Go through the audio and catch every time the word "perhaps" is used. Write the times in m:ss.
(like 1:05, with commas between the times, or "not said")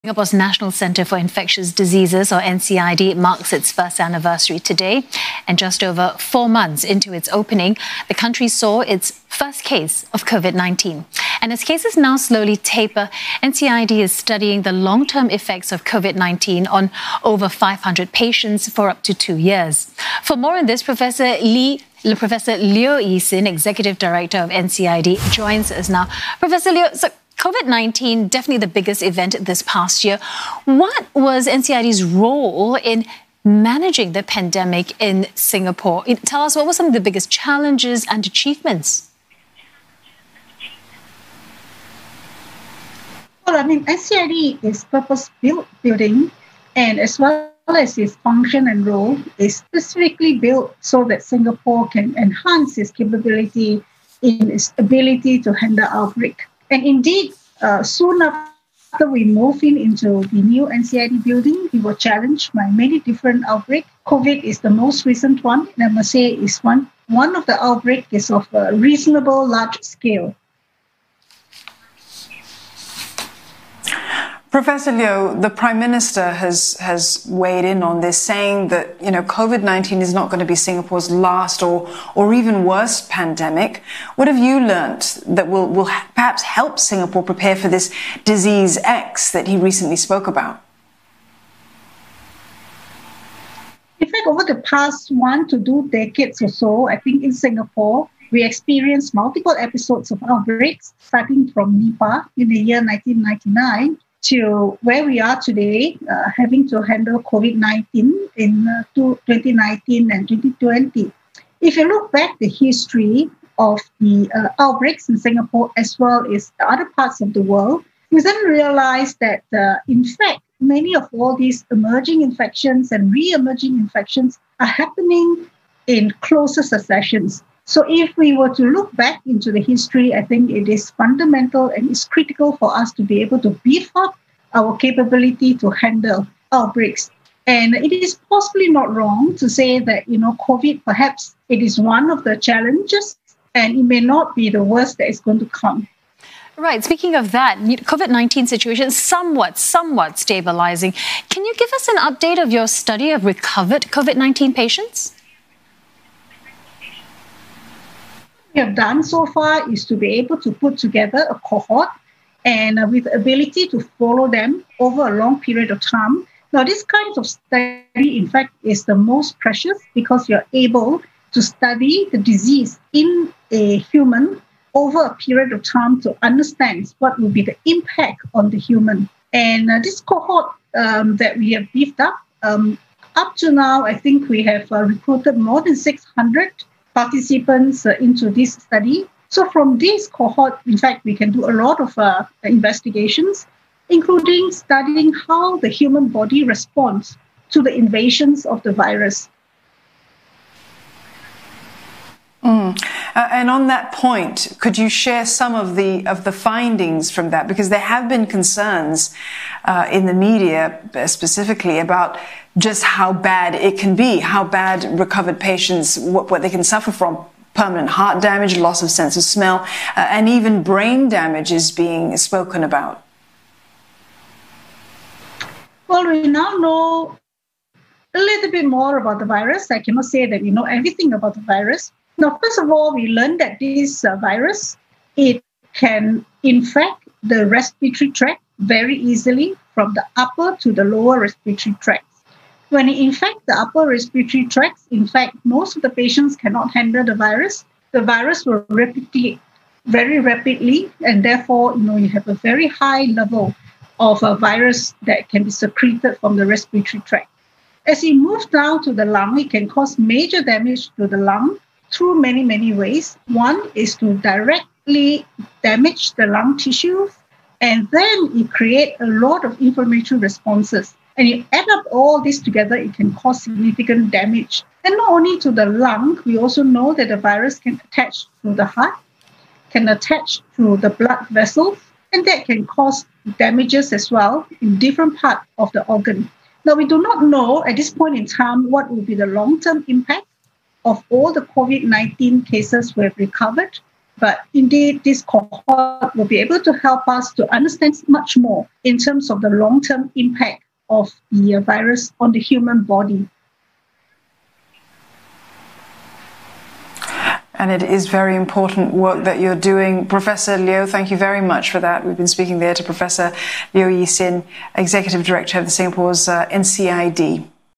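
1:25, 2:20.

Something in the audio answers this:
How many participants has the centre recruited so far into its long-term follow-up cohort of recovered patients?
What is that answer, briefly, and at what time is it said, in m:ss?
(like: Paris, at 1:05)
more than 600, at 3:05.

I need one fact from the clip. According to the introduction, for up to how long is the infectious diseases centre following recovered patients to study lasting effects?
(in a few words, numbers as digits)
2 years.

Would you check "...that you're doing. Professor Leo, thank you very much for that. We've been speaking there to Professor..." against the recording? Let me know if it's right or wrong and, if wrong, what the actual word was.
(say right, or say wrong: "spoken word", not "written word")
right.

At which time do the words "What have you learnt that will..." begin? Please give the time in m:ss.
1:24.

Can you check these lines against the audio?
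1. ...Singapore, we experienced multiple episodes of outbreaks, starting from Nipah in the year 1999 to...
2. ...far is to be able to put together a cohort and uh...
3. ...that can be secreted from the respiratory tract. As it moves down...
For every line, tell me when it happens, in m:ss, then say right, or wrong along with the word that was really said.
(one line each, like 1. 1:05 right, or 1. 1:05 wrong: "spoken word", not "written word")
1. 1:37 right
2. 2:39 right
3. 4:15 right.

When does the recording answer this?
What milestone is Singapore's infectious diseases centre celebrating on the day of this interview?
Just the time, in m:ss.
0:03.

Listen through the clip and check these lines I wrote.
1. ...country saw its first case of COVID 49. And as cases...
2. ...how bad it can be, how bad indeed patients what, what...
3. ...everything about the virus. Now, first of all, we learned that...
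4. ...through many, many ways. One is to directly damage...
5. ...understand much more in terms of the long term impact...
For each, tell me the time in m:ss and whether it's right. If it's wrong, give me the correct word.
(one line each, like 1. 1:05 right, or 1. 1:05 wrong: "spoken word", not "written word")
1. 0:08 wrong: "19", not "49"
2. 3:32 wrong: "recovered", not "indeed"
3. 3:50 right
4. 4:21 right
5. 4:57 right.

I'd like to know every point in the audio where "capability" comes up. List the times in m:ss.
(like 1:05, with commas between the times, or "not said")
0:52, 2:14.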